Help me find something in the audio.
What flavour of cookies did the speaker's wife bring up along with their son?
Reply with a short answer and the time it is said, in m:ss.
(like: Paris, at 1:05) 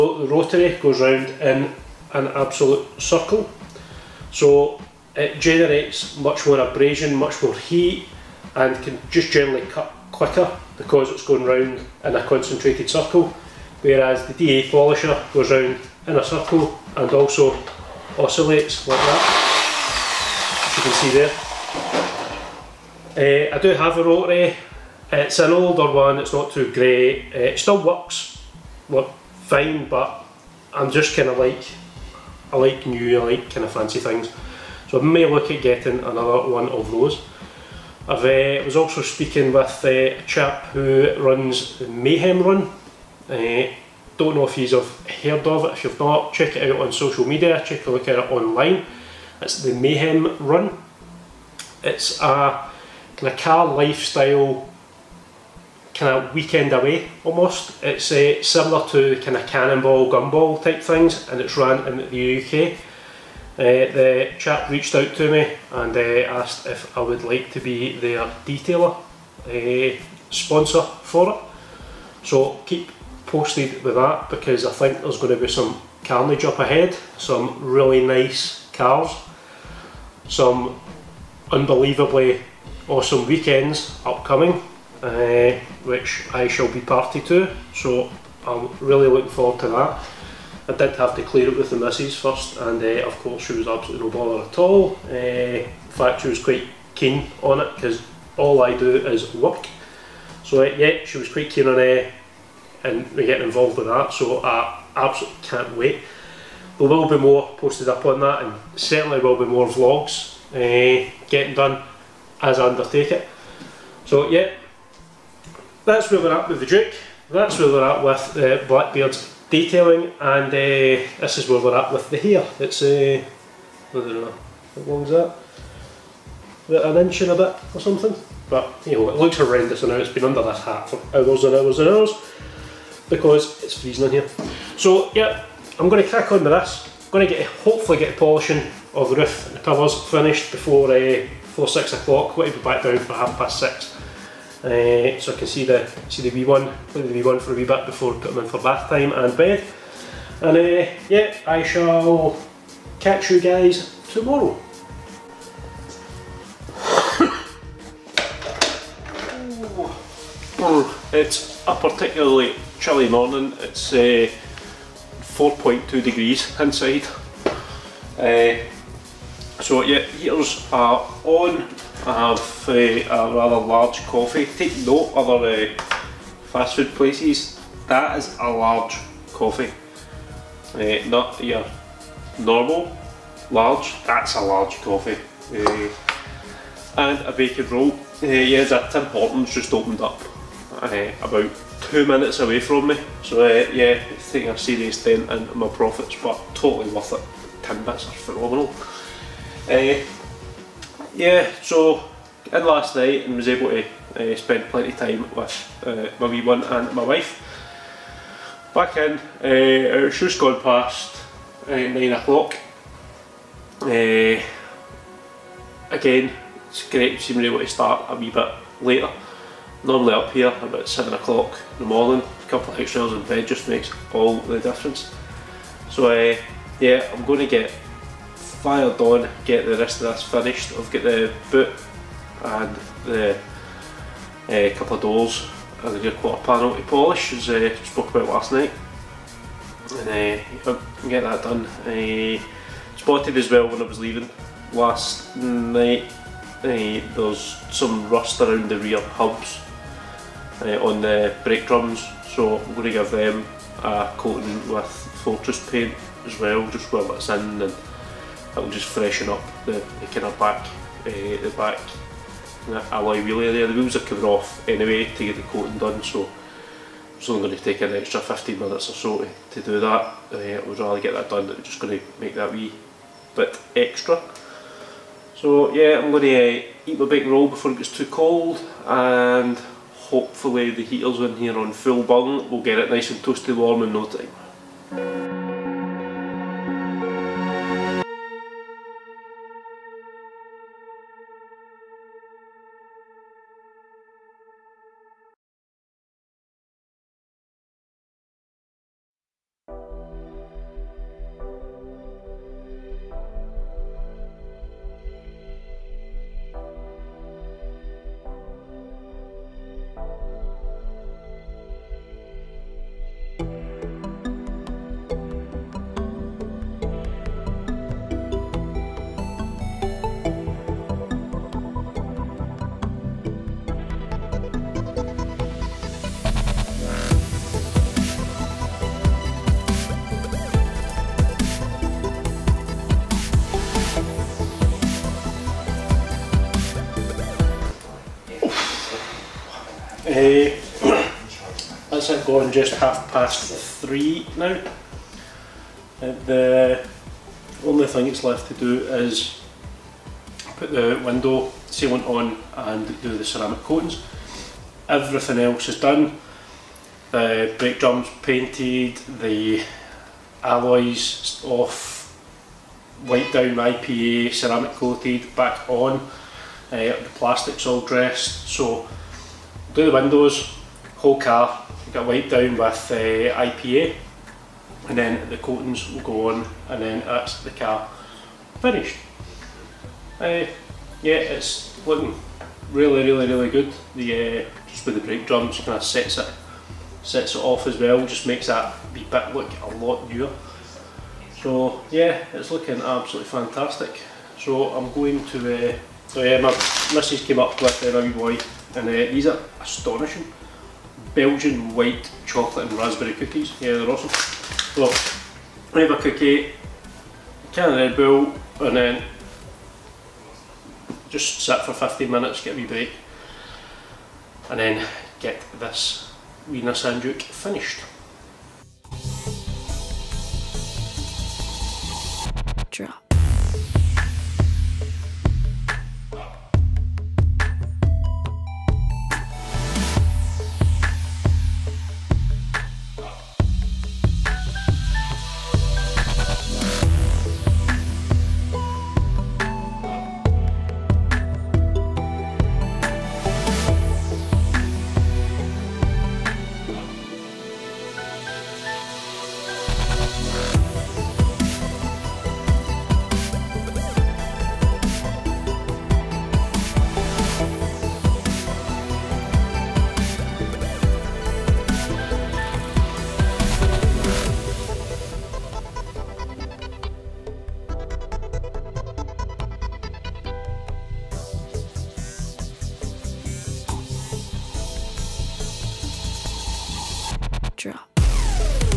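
Belgian white chocolate and raspberry, at 6:41.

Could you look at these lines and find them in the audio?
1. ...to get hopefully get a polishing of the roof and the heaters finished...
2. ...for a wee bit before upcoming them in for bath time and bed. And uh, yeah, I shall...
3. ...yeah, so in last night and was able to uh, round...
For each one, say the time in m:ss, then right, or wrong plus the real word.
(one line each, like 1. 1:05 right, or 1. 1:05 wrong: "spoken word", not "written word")
1. 2:17 wrong: "covers", not "heaters"
2. 2:27 wrong: "putting", not "upcoming"
3. 3:21 wrong: "spend", not "round".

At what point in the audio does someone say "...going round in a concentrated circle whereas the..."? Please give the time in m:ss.
0:11.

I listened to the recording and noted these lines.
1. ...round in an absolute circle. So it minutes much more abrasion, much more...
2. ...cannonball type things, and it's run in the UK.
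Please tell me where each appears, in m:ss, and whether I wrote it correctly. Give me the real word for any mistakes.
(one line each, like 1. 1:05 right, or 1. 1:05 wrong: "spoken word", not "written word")
1. 0:01 wrong: "generates", not "minutes"
2. 1:00 wrong: "gumball", not "cannonball".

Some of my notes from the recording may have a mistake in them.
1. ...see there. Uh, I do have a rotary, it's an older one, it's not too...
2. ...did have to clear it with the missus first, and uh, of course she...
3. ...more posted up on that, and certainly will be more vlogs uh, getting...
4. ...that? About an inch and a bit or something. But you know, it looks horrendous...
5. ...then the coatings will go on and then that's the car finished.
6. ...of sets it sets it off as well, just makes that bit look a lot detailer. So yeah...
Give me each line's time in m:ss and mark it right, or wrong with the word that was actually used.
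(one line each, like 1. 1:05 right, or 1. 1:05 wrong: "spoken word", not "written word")
1. 0:21 right
2. 1:30 right
3. 1:47 right
4. 2:05 right
5. 6:14 right
6. 6:25 wrong: "newer", not "detailer".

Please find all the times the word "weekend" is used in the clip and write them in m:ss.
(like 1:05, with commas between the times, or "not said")
0:56, 1:23.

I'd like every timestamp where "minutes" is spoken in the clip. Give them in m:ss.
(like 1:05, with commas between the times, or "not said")
3:12, 4:28, 6:52.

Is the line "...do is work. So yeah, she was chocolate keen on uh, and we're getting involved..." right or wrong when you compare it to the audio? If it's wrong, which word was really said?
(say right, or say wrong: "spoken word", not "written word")
wrong: "quite", not "chocolate".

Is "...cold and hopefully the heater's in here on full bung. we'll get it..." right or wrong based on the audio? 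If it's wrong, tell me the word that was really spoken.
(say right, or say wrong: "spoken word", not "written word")
right.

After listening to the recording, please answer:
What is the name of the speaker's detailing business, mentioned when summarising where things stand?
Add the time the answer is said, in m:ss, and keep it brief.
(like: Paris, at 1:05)
Blackbeard's detailing, at 1:58.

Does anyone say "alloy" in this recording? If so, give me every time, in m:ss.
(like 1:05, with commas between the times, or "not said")
4:22, 6:00.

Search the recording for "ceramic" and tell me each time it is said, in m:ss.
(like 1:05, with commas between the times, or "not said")
5:53, 6:04.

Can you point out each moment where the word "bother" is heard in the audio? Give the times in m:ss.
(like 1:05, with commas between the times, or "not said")
1:34.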